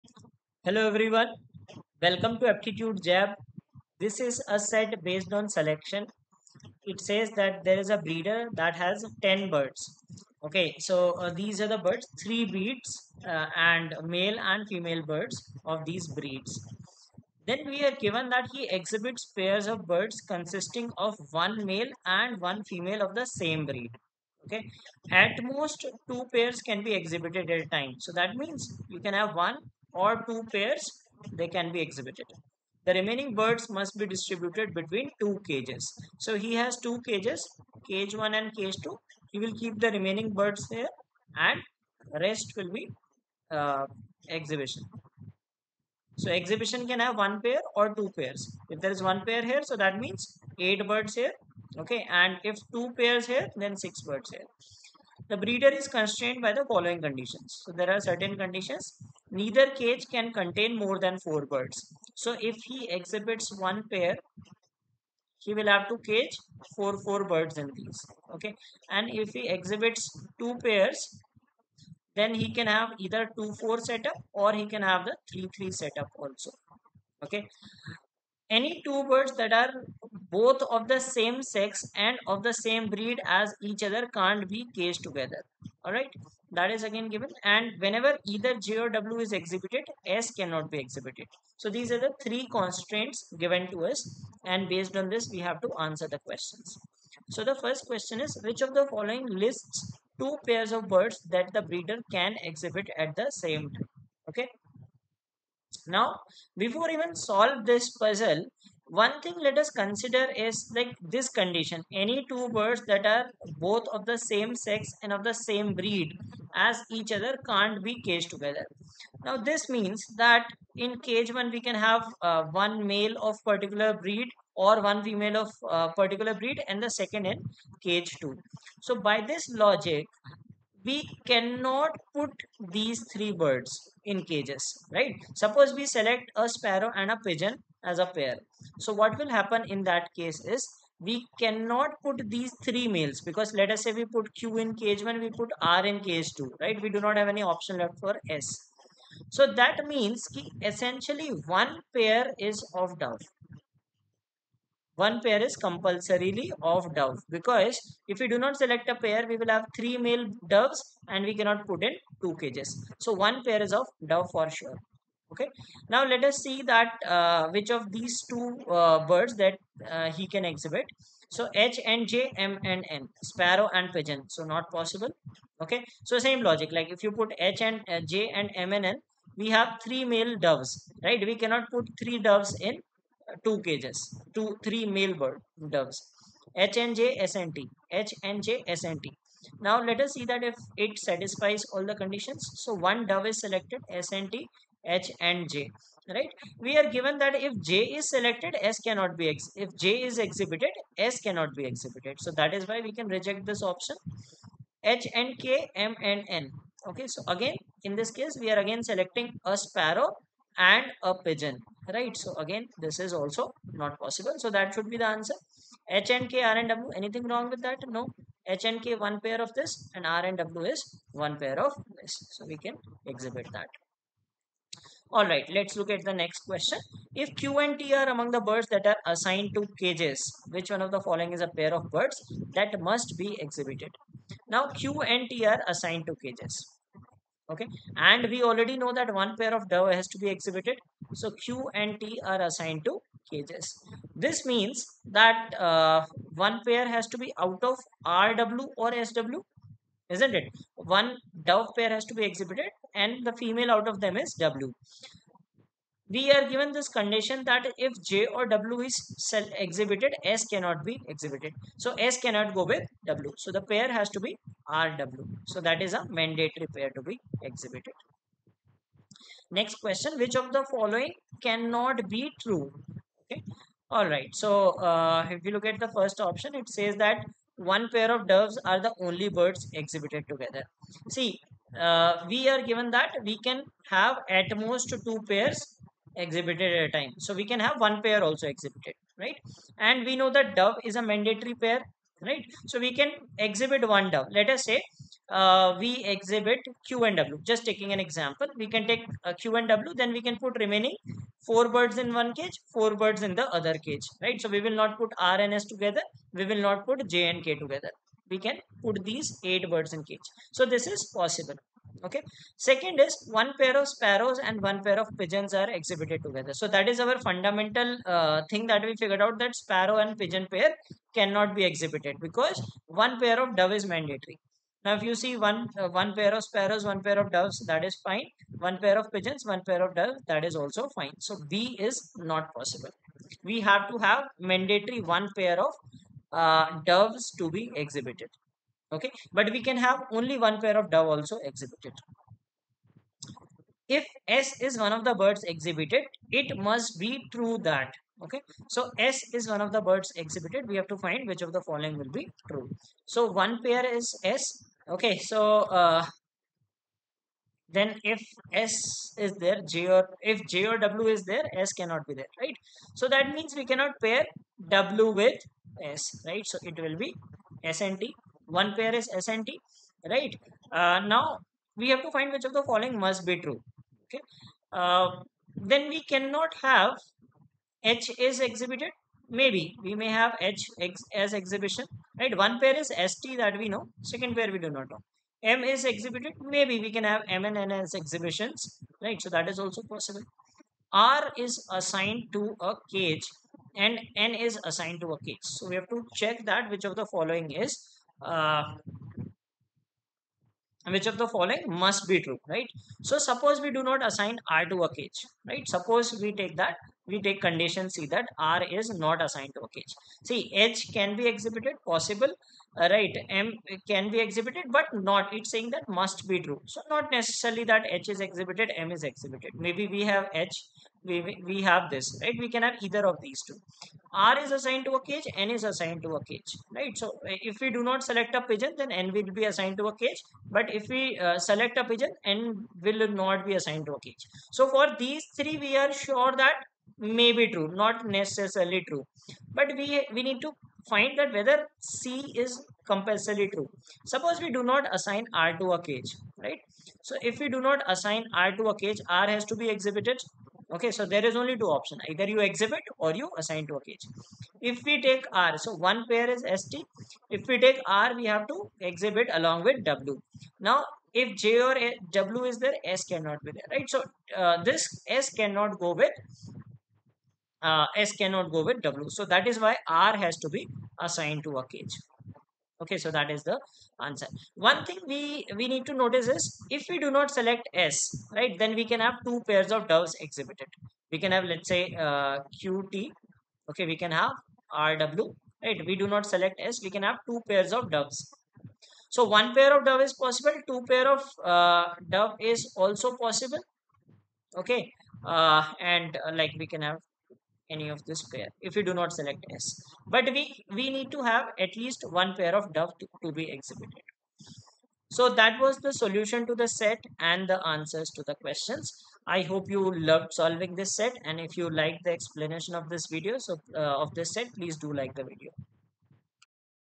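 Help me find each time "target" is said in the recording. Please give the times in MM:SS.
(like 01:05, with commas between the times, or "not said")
not said.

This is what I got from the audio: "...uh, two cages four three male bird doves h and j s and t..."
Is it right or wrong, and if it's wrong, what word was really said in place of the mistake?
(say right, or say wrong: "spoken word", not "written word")
wrong: "two", not "four".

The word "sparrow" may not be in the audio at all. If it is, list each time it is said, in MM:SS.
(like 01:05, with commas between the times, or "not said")
02:16, 02:53, 03:29, 05:13, 05:19, 05:26.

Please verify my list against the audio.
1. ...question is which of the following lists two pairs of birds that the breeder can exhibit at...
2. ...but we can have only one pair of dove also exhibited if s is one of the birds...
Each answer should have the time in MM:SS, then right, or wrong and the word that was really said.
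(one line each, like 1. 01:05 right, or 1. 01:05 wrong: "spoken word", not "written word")
1. 01:37 right
2. 05:39 right.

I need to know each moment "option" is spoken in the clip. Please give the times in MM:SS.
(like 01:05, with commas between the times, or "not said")
02:27, 03:23, 04:36, 07:31.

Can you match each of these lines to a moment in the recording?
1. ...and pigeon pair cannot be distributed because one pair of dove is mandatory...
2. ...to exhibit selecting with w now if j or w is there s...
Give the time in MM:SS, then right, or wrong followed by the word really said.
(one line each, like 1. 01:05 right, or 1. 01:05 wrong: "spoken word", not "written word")
1. 05:20 wrong: "exhibited", not "distributed"
2. 07:38 wrong: "along", not "selecting".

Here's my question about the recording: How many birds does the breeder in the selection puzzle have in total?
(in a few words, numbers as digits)
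10.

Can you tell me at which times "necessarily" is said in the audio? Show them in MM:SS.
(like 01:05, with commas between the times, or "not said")
06:57, 07:18.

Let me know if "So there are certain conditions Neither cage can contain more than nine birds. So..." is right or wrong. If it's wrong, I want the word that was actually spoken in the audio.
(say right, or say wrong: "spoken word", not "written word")
wrong: "four", not "nine".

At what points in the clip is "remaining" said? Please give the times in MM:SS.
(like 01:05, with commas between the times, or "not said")
00:32, 00:39, 05:00.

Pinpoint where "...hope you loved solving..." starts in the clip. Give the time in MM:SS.
08:29.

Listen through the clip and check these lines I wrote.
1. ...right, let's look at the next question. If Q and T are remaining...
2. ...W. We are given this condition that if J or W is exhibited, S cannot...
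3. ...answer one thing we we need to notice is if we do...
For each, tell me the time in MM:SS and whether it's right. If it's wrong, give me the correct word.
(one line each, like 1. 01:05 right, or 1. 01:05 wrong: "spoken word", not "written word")
1. 03:45 wrong: "among", not "remaining"
2. 04:14 right
3. 07:54 right.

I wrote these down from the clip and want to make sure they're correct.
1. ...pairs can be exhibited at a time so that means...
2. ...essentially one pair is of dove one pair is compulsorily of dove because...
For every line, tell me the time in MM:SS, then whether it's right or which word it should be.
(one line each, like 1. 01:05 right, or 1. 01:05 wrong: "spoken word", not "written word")
1. 00:26 right
2. 02:30 right.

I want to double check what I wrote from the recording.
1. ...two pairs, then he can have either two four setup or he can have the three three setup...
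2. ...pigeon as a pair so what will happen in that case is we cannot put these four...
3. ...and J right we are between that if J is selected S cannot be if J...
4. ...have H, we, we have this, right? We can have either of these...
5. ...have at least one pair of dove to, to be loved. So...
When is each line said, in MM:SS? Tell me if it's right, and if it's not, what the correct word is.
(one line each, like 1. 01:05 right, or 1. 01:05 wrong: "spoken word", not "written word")
1. 01:10 right
2. 02:17 wrong: "three", not "four"
3. 03:15 wrong: "given", not "between"
4. 07:00 right
5. 08:21 wrong: "exhibited", not "loved".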